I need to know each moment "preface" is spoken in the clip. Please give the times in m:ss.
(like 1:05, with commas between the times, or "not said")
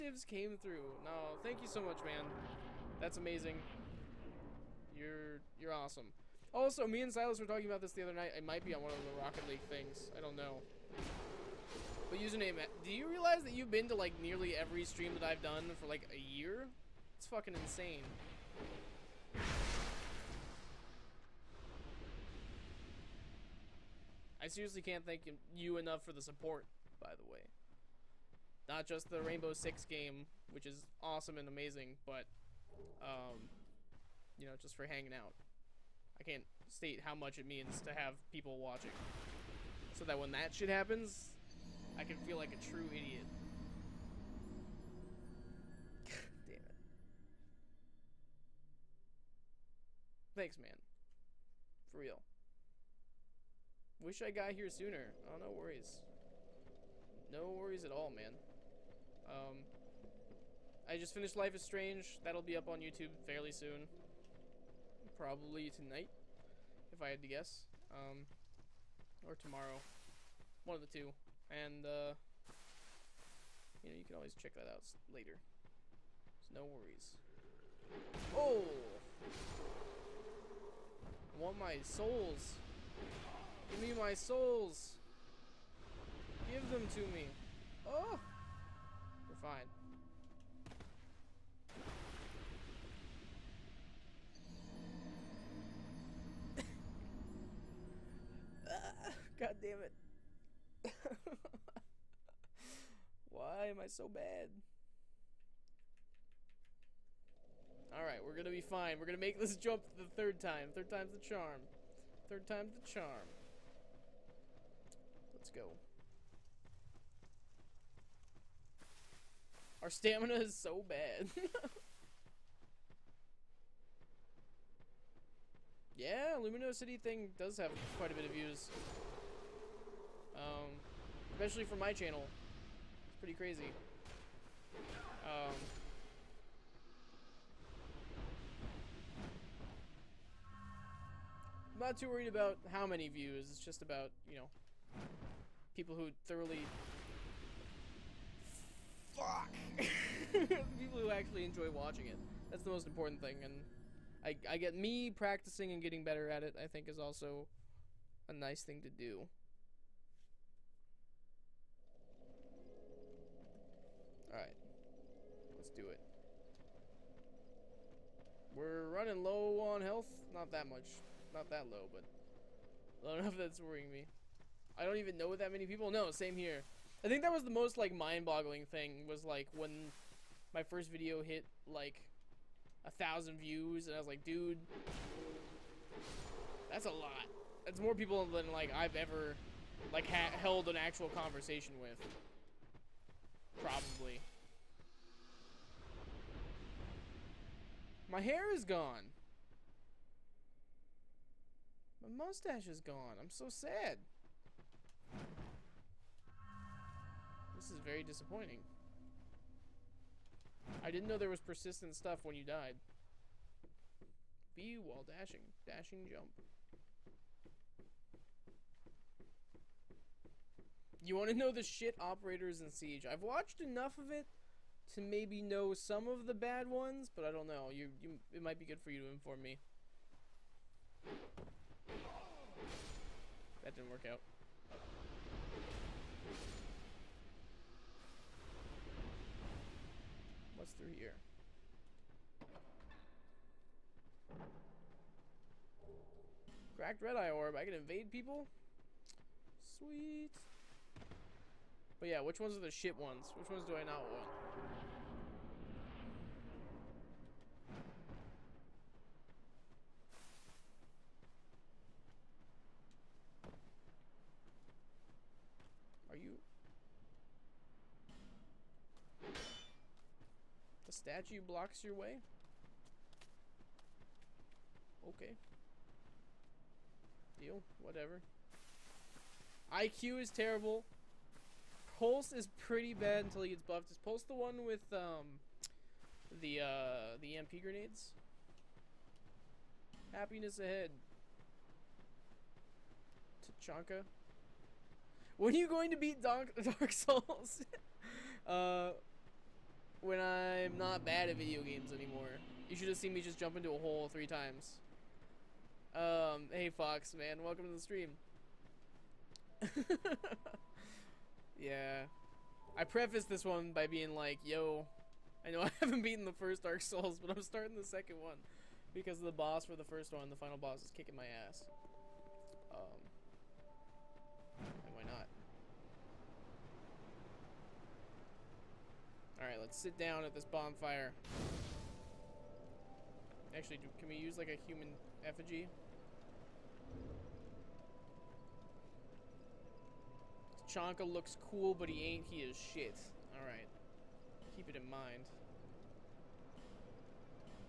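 5:12.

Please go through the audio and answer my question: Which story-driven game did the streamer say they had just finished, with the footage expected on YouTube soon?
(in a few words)
Life is Strange.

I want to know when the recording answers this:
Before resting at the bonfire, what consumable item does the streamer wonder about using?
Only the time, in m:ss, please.
5:34.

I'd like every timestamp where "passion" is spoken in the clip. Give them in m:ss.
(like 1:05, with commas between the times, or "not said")
not said.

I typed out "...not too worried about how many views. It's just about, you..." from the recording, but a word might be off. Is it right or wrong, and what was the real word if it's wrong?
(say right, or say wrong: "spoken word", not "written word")
right.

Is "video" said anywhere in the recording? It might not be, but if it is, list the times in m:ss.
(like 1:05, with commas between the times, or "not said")
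3:00, 5:01.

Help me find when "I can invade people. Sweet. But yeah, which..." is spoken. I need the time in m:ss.
4:07.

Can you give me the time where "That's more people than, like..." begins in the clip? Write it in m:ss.
3:07.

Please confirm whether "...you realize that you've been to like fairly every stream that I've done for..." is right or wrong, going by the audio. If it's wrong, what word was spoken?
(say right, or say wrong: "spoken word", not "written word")
wrong: "nearly", not "fairly".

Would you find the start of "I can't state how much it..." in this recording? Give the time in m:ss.
0:36.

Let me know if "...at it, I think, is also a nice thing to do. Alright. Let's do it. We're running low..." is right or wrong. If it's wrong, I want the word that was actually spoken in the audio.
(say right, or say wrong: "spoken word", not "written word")
right.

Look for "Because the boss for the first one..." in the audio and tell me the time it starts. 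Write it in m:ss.
5:18.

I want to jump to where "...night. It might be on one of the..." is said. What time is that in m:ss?
0:08.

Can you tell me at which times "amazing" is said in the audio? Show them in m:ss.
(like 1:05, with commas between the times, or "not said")
0:03, 0:31.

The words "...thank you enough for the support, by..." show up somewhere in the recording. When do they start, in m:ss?
0:25.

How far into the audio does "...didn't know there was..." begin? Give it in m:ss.
3:30.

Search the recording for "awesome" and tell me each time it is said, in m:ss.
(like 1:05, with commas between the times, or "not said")
0:05, 0:31.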